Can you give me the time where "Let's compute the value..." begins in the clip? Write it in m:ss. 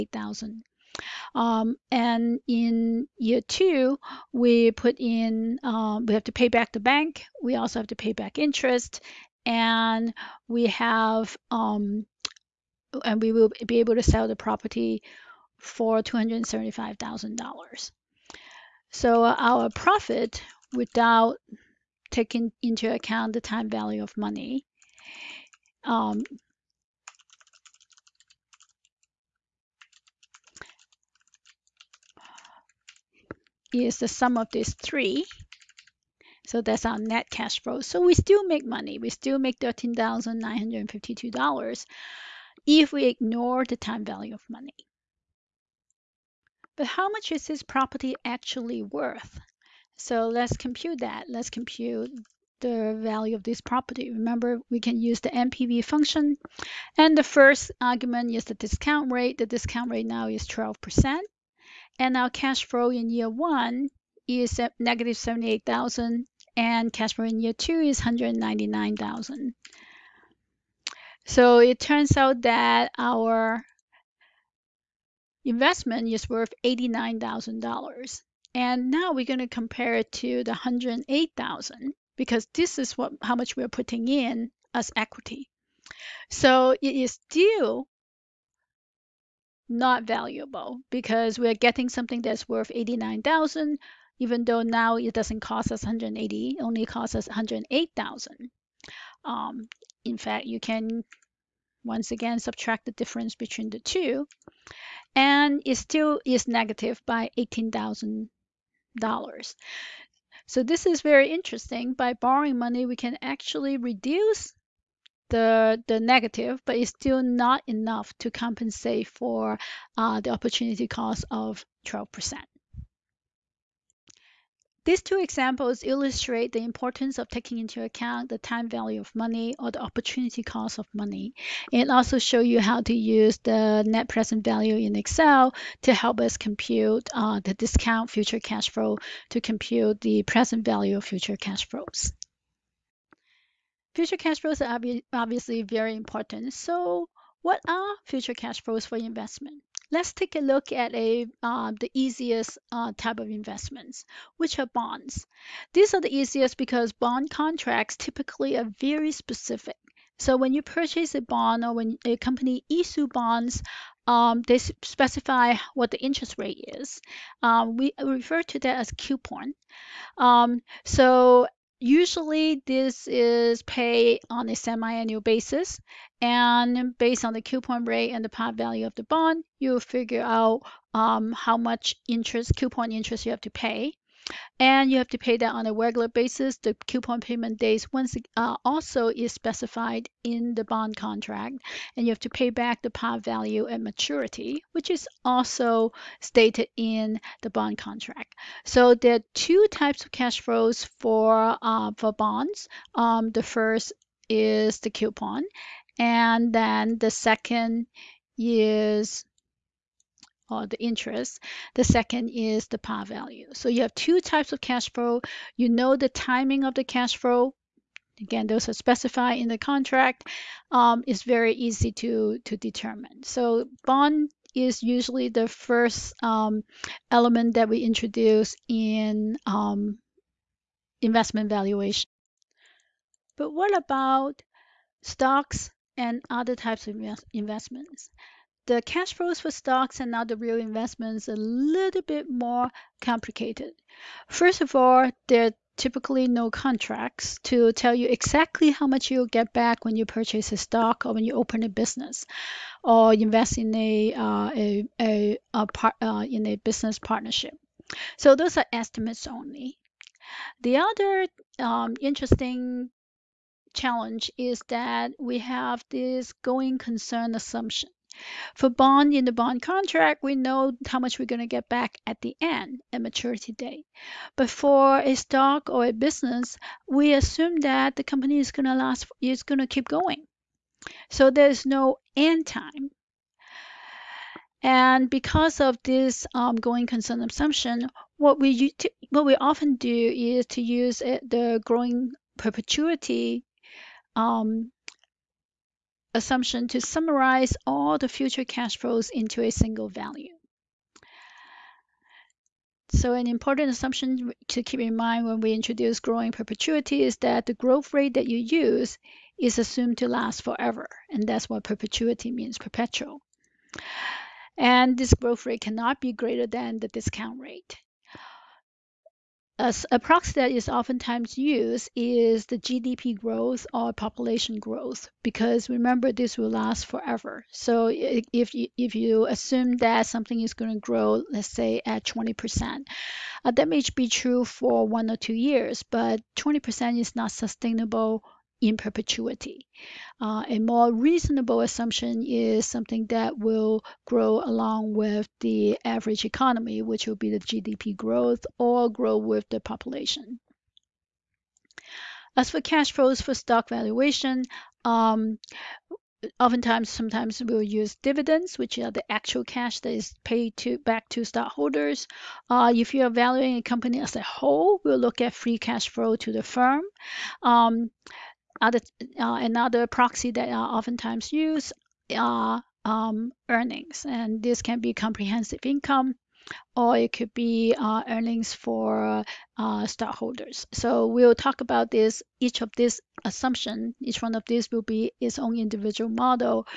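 0:51.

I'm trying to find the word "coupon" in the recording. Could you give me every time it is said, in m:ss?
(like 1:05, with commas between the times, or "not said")
2:48, 2:57, 3:02, 3:06, 3:24.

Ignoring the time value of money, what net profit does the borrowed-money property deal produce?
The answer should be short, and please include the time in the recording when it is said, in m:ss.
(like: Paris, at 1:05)
$13,952, at 0:39.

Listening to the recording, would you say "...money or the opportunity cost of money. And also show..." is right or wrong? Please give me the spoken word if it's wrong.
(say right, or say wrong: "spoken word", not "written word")
right.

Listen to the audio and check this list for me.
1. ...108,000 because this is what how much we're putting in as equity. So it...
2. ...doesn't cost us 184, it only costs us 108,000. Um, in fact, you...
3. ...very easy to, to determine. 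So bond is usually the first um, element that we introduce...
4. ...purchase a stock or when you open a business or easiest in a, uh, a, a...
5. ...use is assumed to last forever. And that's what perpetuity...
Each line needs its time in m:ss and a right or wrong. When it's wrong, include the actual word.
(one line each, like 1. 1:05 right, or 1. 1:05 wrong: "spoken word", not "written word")
1. 1:20 right
2. 1:35 wrong: "180", not "184"
3. 3:41 right
4. 4:10 wrong: "invest", not "easiest"
5. 5:08 right.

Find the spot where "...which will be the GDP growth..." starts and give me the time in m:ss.
5:46.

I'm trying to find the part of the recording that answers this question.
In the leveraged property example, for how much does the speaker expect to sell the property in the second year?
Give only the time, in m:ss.
0:16.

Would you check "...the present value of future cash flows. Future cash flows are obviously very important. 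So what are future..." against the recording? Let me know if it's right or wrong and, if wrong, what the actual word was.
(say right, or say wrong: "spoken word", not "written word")
right.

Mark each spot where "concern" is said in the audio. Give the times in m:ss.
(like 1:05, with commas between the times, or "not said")
4:26, 4:46.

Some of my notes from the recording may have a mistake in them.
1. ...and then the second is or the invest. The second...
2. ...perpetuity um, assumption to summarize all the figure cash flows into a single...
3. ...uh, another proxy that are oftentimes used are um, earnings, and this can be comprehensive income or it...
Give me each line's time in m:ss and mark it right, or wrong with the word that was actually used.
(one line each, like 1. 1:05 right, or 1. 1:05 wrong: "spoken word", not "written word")
1. 3:25 wrong: "interest", not "invest"
2. 4:52 wrong: "future", not "figure"
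3. 6:09 right.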